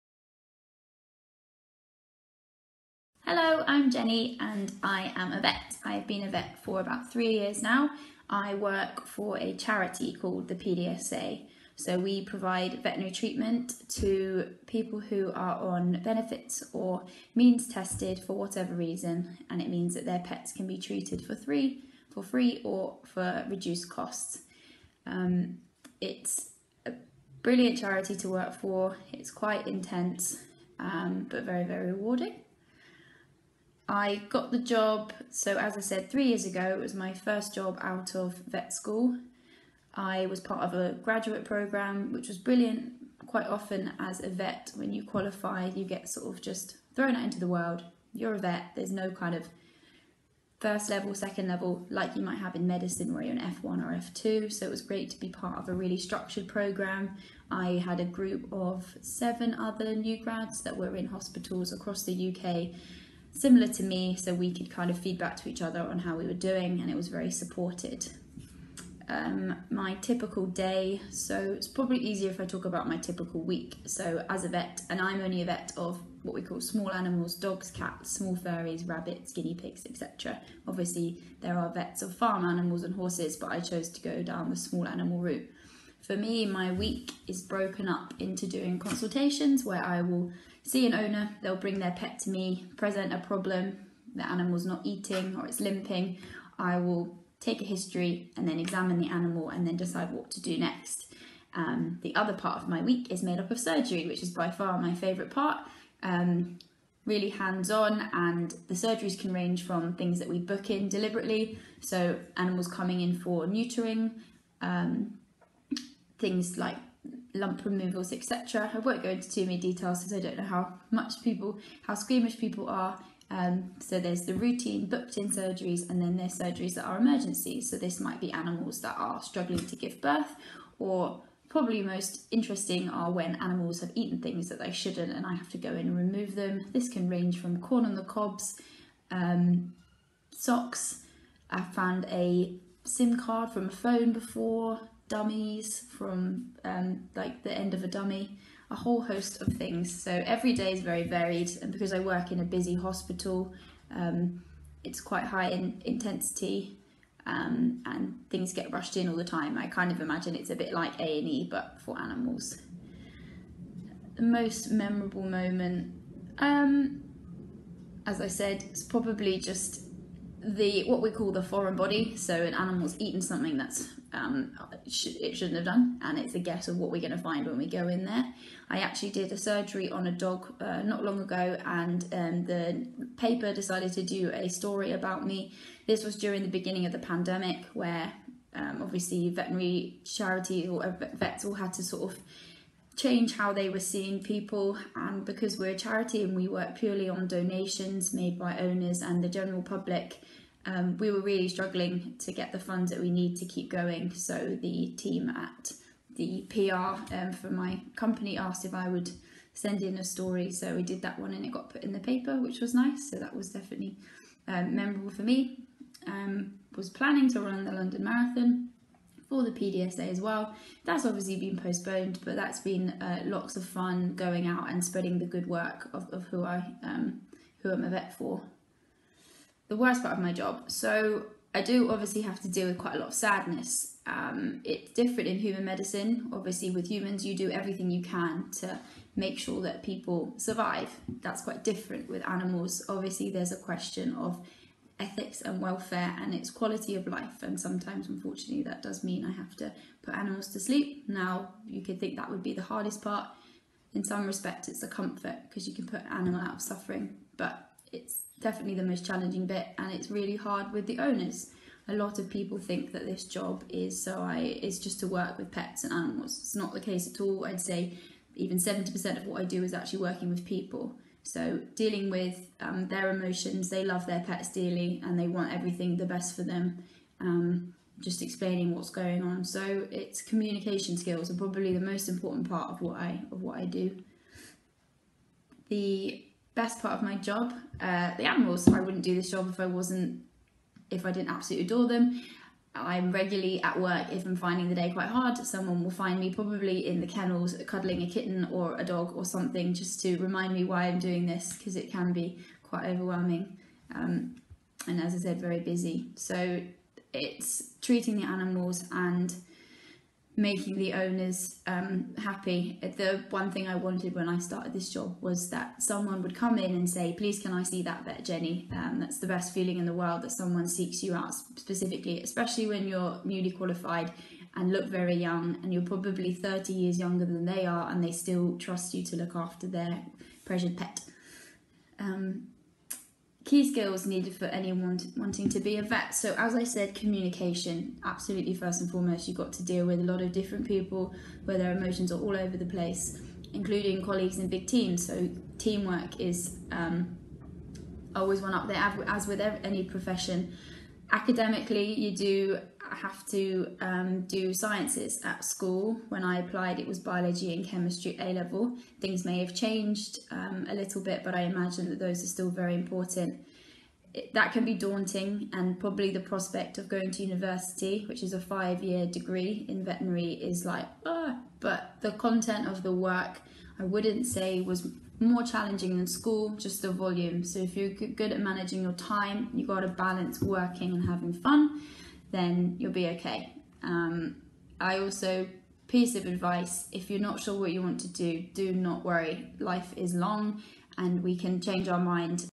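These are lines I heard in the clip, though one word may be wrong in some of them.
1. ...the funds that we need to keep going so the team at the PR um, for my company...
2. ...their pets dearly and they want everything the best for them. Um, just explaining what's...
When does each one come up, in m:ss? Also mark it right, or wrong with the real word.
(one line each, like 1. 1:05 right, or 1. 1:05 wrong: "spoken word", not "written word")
1. 3:22 right
2. 4:34 right.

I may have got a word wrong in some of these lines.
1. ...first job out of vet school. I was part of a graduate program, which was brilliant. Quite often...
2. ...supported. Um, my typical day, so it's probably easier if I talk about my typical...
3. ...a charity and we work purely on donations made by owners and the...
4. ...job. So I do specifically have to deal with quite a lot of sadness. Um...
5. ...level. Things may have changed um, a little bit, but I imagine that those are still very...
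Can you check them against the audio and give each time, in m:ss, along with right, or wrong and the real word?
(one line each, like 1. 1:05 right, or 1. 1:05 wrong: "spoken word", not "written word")
1. 0:37 right
2. 1:07 right
3. 3:15 right
4. 3:50 wrong: "obviously", not "specifically"
5. 5:58 right.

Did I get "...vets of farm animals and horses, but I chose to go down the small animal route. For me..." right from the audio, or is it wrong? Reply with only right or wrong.
right.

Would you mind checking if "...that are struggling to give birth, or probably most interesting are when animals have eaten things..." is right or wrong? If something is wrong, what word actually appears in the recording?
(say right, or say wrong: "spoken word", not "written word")
right.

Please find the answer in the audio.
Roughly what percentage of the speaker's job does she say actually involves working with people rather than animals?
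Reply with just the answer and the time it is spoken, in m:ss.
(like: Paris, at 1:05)
70%, at 4:28.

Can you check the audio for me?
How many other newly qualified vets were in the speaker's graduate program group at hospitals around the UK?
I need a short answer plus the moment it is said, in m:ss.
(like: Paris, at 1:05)
7, at 0:59.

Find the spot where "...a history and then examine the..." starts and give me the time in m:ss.
1:37.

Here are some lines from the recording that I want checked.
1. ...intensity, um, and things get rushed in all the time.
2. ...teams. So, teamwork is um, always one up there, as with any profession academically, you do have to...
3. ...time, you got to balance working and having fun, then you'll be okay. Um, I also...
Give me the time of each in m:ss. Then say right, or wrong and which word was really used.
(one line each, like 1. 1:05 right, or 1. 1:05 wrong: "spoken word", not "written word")
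1. 2:35 right
2. 5:44 right
3. 6:18 right.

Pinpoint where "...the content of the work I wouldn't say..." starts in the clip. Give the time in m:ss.
6:12.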